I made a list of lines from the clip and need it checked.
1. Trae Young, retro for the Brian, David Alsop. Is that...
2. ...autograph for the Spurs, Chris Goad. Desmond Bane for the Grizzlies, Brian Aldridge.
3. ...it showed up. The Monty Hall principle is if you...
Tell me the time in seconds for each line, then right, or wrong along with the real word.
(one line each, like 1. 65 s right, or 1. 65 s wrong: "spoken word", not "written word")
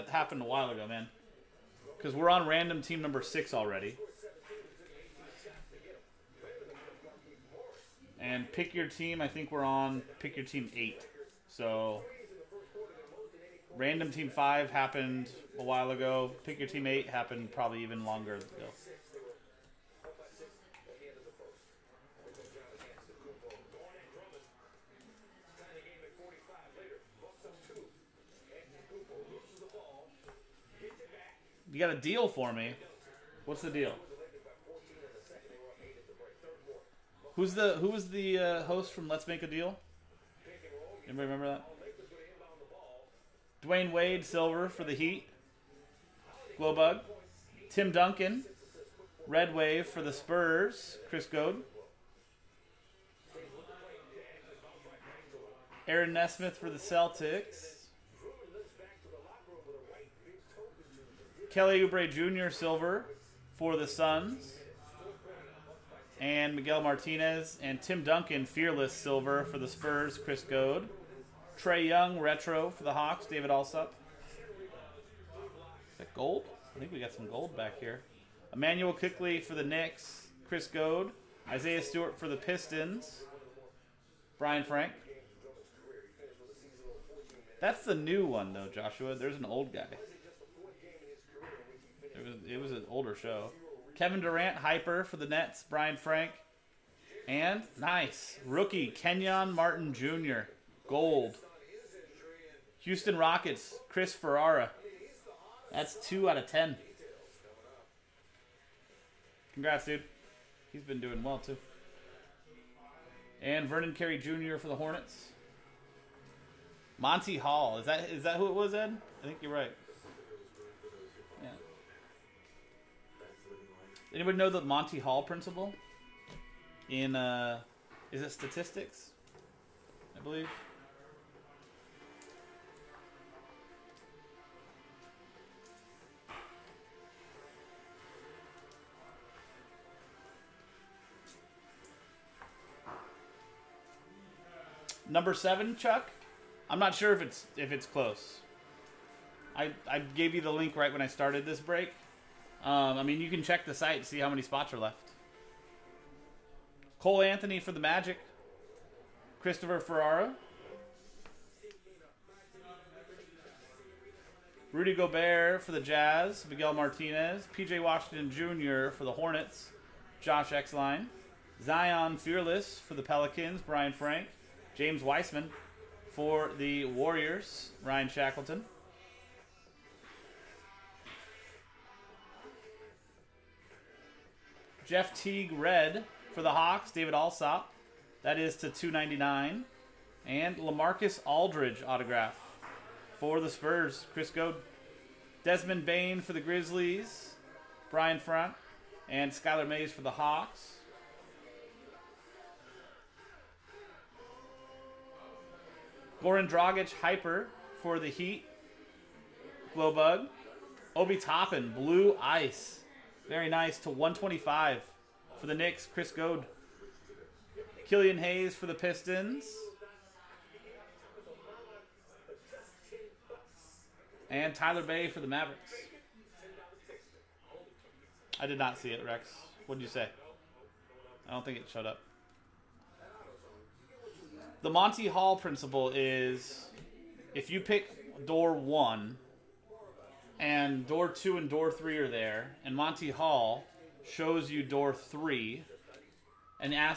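1. 71 s wrong: "Hawks", not "Brian"
2. 191 s wrong: "Front", not "Aldridge"
3. 231 s right.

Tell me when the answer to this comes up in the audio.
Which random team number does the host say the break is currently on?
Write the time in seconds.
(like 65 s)
3 s.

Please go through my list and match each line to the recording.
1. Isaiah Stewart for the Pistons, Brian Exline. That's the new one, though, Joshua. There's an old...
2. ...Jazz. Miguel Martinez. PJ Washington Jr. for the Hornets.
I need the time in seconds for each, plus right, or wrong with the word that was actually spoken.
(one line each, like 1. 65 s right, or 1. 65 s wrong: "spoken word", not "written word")
1. 81 s wrong: "Frank", not "Exline"
2. 165 s right.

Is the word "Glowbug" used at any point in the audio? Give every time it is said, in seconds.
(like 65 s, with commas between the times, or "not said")
46 s, 209 s.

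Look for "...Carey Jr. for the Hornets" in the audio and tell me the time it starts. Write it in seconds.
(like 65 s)
113 s.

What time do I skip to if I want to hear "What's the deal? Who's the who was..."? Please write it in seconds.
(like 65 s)
33 s.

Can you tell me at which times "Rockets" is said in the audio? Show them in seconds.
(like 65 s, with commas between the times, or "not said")
103 s.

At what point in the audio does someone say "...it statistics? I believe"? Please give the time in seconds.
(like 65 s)
128 s.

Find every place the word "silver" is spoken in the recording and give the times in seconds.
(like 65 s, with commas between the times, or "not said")
44 s, 62 s, 68 s.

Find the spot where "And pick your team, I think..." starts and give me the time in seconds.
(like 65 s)
8 s.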